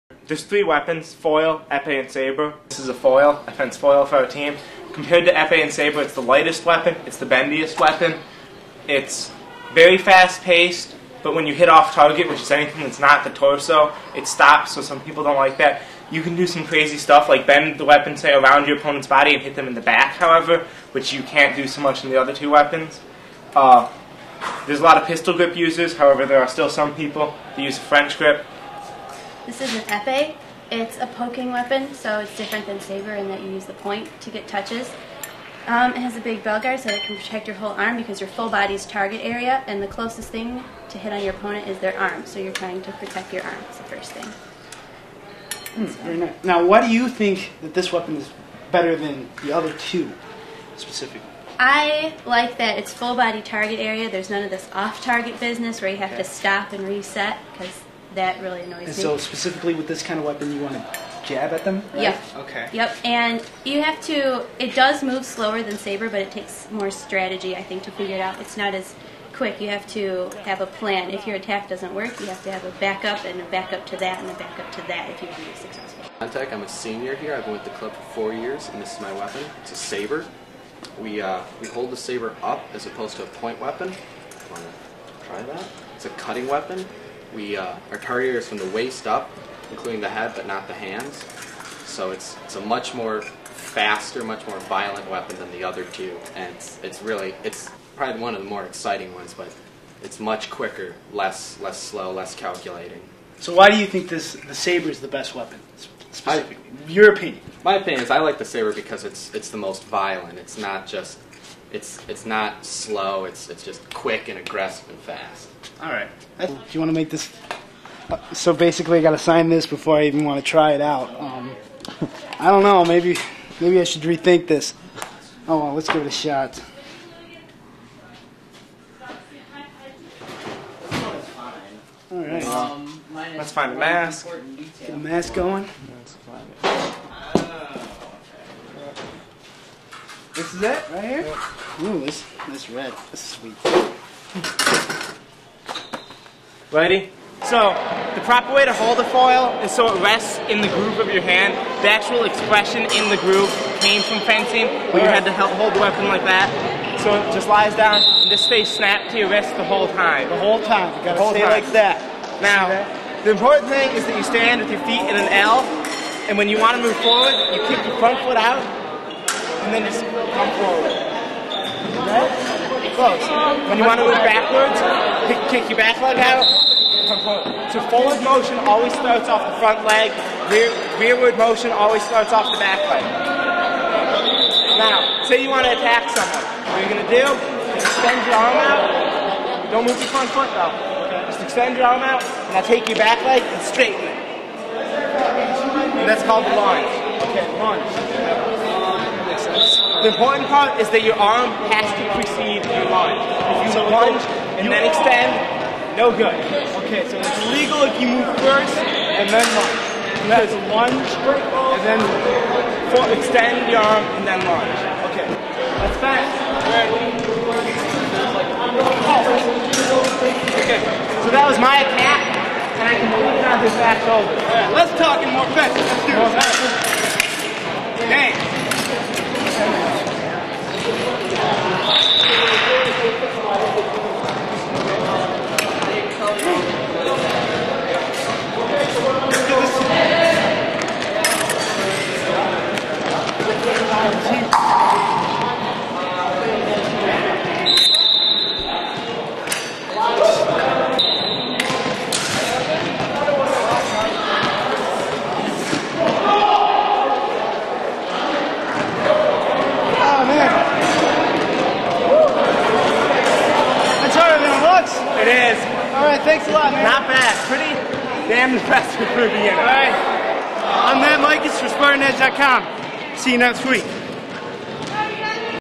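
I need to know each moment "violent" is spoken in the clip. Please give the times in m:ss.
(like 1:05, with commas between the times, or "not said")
1:34, 1:49.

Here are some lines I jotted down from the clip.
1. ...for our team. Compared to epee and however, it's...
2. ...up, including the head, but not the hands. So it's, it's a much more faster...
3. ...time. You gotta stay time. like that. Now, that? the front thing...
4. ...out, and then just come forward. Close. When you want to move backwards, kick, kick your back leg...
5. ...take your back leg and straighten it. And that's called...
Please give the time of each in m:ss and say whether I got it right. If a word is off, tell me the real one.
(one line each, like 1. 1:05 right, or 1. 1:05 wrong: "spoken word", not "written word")
1. 0:04 wrong: "saber", not "however"
2. 1:29 right
3. 2:40 wrong: "important", not "front"
4. 2:48 right
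5. 3:12 right.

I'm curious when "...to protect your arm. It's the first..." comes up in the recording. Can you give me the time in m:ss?
0:42.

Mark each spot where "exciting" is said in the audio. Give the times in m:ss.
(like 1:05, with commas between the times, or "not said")
1:38.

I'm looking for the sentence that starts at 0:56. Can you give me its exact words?
to stop and reset because that really annoys and me.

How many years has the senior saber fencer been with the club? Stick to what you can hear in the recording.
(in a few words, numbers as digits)
4.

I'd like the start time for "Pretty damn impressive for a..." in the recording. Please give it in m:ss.
4:27.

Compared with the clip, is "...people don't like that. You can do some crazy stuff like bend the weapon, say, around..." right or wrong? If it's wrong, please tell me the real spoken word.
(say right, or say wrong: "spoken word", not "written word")
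right.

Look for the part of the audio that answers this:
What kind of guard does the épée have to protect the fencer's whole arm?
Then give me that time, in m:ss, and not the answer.
0:36.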